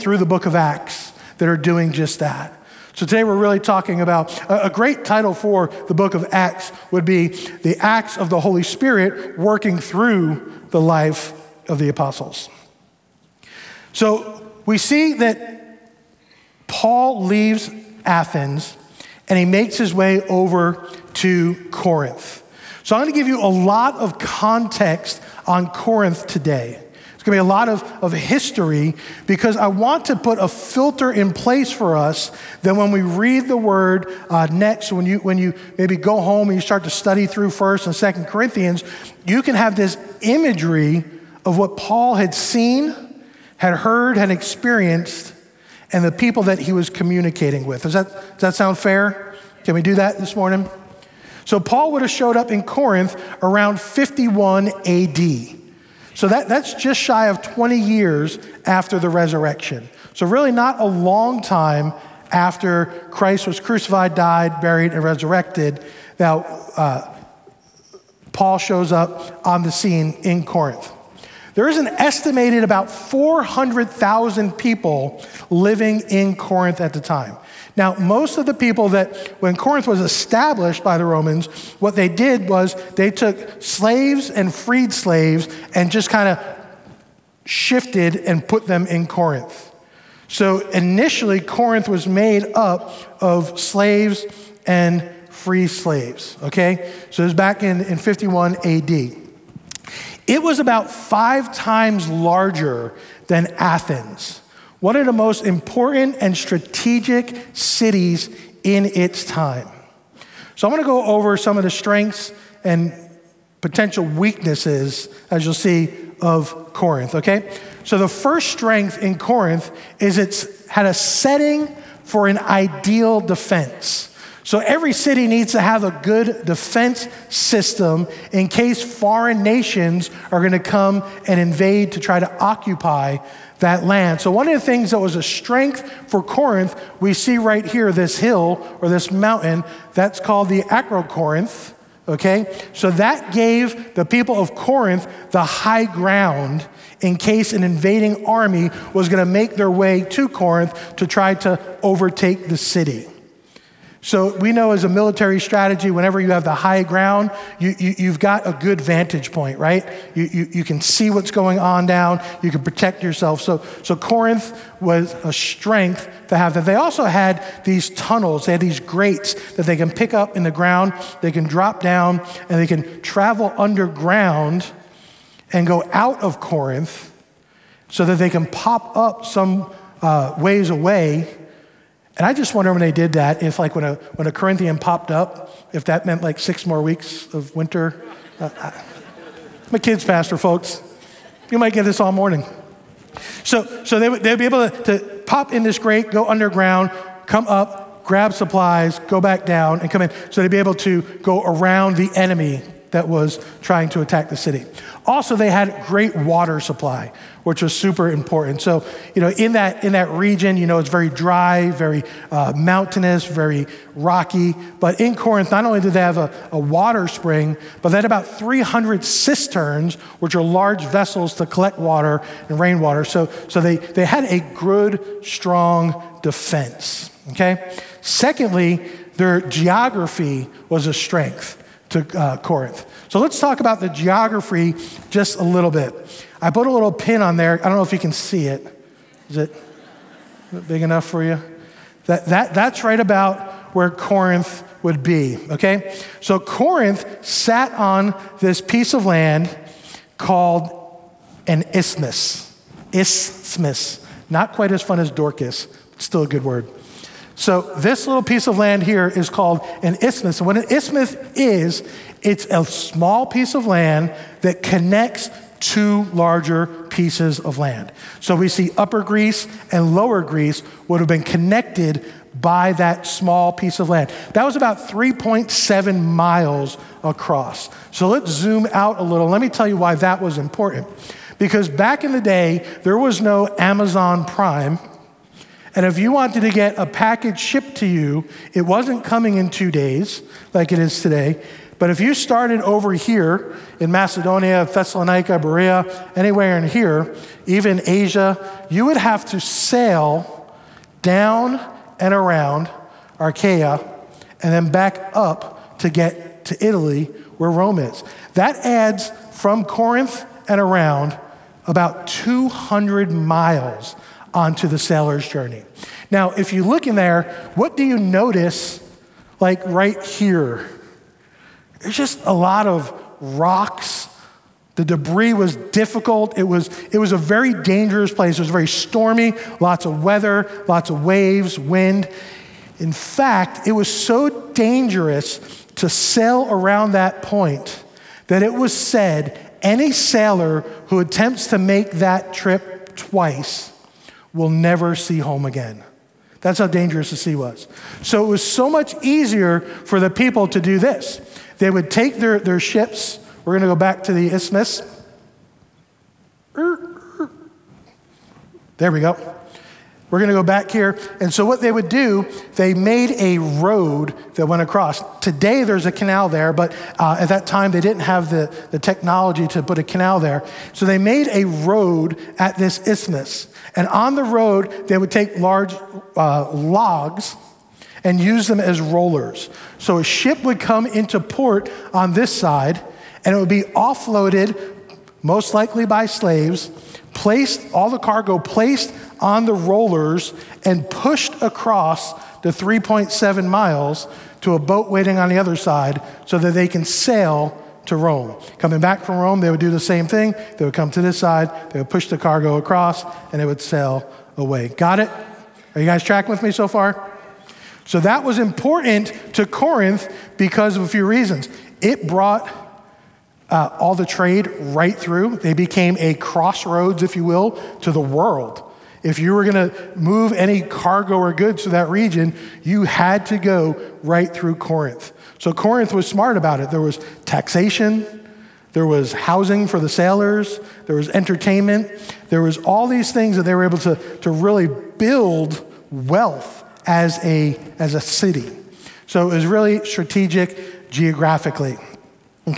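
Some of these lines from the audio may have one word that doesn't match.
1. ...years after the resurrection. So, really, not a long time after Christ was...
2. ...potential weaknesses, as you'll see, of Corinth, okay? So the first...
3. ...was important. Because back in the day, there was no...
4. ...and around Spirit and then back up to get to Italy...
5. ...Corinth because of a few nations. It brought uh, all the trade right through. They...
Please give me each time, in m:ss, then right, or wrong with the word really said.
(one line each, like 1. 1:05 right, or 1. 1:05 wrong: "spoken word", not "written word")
1. 0:57 right
2. 1:53 right
3. 4:40 right
4. 5:01 wrong: "Achaia", not "Spirit"
5. 6:49 wrong: "reasons", not "nations".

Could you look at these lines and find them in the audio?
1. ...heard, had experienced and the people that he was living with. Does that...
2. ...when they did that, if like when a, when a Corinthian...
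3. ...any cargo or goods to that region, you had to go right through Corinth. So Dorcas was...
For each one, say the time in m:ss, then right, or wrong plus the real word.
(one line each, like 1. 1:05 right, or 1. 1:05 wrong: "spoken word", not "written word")
1. 0:43 wrong: "communicating", not "living"
2. 3:02 right
3. 7:00 wrong: "Corinth", not "Dorcas".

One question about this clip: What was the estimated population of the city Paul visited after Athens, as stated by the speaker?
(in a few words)
400,000.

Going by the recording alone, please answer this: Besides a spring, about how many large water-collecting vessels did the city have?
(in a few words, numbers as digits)
300.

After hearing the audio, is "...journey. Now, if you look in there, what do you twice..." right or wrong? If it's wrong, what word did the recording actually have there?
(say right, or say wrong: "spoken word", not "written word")
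wrong: "notice", not "twice".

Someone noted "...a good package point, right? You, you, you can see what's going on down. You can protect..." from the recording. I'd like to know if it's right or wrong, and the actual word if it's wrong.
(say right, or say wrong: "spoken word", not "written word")
wrong: "vantage", not "package".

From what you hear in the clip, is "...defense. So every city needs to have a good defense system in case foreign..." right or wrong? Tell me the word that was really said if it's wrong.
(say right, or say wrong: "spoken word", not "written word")
right.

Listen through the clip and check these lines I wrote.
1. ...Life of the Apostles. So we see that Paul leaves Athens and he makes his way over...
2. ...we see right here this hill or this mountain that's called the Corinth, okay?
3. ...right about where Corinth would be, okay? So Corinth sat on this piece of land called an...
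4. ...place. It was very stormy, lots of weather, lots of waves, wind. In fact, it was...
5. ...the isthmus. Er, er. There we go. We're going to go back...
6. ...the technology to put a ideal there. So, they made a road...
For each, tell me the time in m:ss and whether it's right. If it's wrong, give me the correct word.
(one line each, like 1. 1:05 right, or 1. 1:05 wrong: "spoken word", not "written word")
1. 0:10 right
2. 2:16 wrong: "Acrocorinth", not "Corinth"
3. 4:02 right
4. 5:28 right
5. 5:54 right
6. 6:08 wrong: "canal", not "ideal".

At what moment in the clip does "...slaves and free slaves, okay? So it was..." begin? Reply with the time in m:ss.
1:33.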